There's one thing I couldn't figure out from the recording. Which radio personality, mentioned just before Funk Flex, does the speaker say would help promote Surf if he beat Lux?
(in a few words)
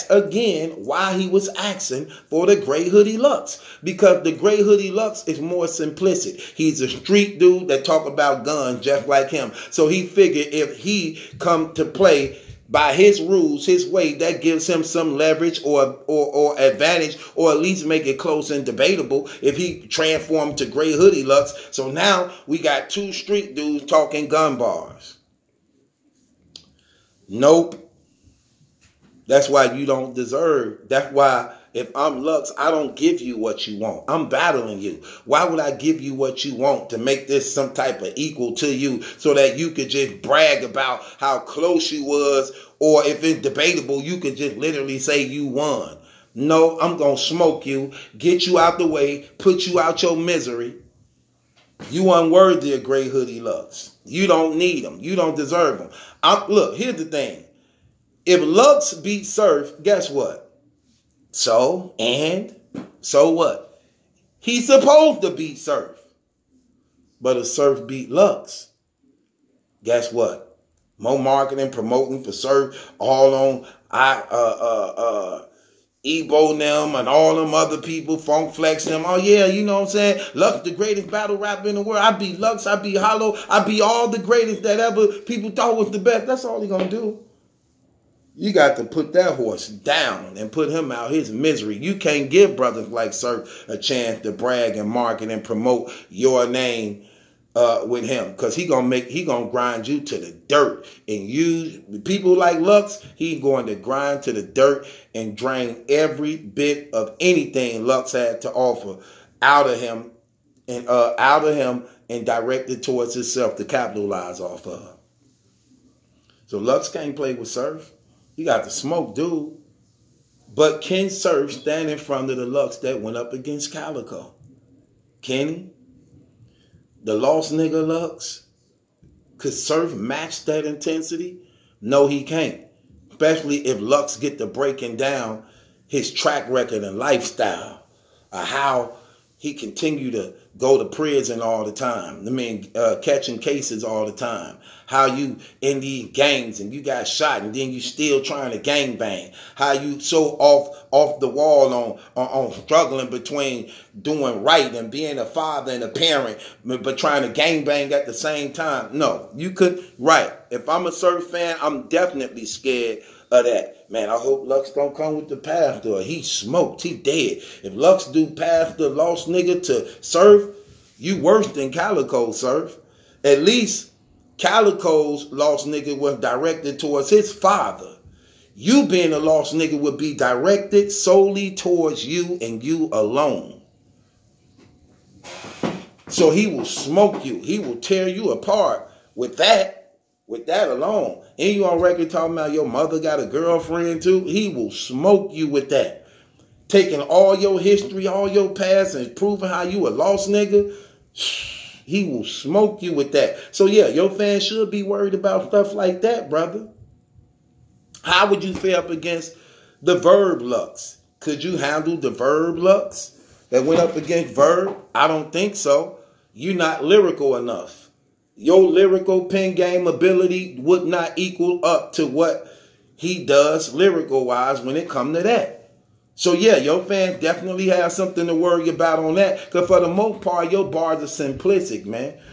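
Ebro.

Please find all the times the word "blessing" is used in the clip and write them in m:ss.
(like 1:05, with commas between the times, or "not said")
not said.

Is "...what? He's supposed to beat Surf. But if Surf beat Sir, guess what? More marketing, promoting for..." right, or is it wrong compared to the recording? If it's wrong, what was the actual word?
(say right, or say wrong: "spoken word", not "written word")
wrong: "Lux", not "Sir".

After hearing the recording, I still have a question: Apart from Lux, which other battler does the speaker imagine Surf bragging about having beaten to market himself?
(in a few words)
Hollow.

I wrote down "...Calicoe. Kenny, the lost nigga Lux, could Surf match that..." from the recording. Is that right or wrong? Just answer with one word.
right.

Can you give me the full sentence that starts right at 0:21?
So now we got two street dudes talking gun bars.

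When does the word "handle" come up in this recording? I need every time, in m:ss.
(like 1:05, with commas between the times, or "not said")
3:31.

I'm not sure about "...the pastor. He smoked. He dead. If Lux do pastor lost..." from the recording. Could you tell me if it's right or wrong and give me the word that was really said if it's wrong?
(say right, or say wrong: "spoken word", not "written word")
right.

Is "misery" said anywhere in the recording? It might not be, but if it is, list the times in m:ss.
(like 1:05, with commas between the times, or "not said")
0:50, 1:31.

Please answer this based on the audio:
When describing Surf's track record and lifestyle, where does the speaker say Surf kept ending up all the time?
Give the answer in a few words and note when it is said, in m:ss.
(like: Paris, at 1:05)
prison, at 2:20.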